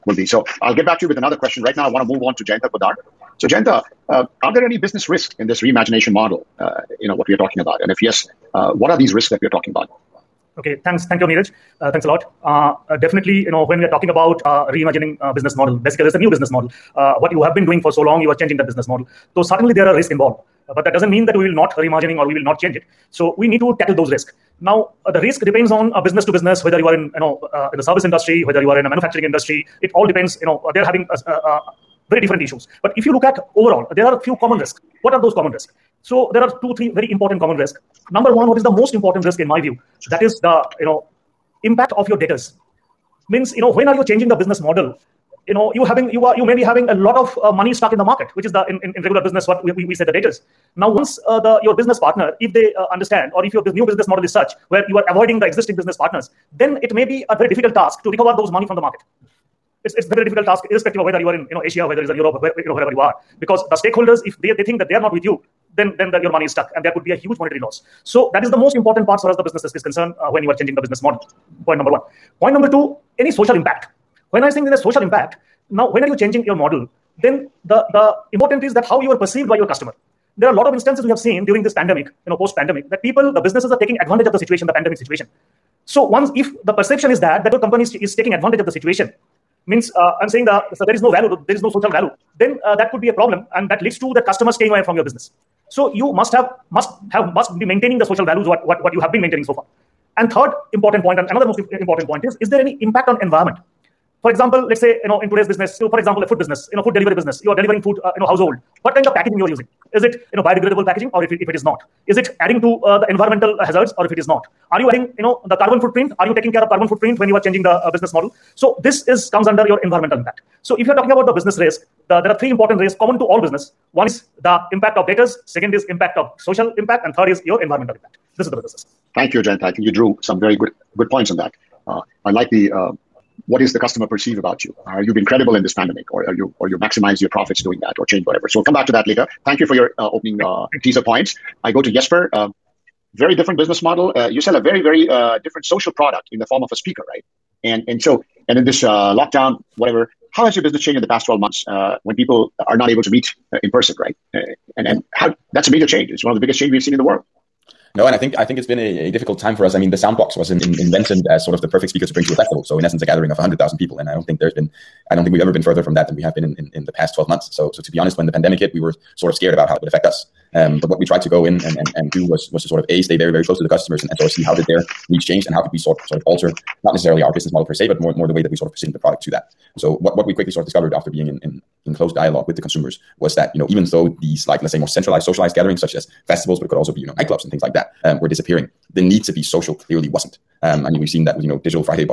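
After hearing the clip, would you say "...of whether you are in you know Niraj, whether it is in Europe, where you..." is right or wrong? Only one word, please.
wrong.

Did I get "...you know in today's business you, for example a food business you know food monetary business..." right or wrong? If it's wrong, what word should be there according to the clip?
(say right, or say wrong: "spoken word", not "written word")
wrong: "delivery", not "monetary".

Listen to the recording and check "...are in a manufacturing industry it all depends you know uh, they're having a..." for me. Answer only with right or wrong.
right.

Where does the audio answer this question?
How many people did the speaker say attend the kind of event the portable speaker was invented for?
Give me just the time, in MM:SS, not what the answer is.
02:43.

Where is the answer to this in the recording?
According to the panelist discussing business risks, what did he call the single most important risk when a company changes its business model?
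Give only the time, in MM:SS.
00:41.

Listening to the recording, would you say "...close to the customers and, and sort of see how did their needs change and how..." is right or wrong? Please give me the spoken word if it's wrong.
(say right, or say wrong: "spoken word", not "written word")
right.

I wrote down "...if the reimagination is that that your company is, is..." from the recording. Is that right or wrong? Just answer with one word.
wrong.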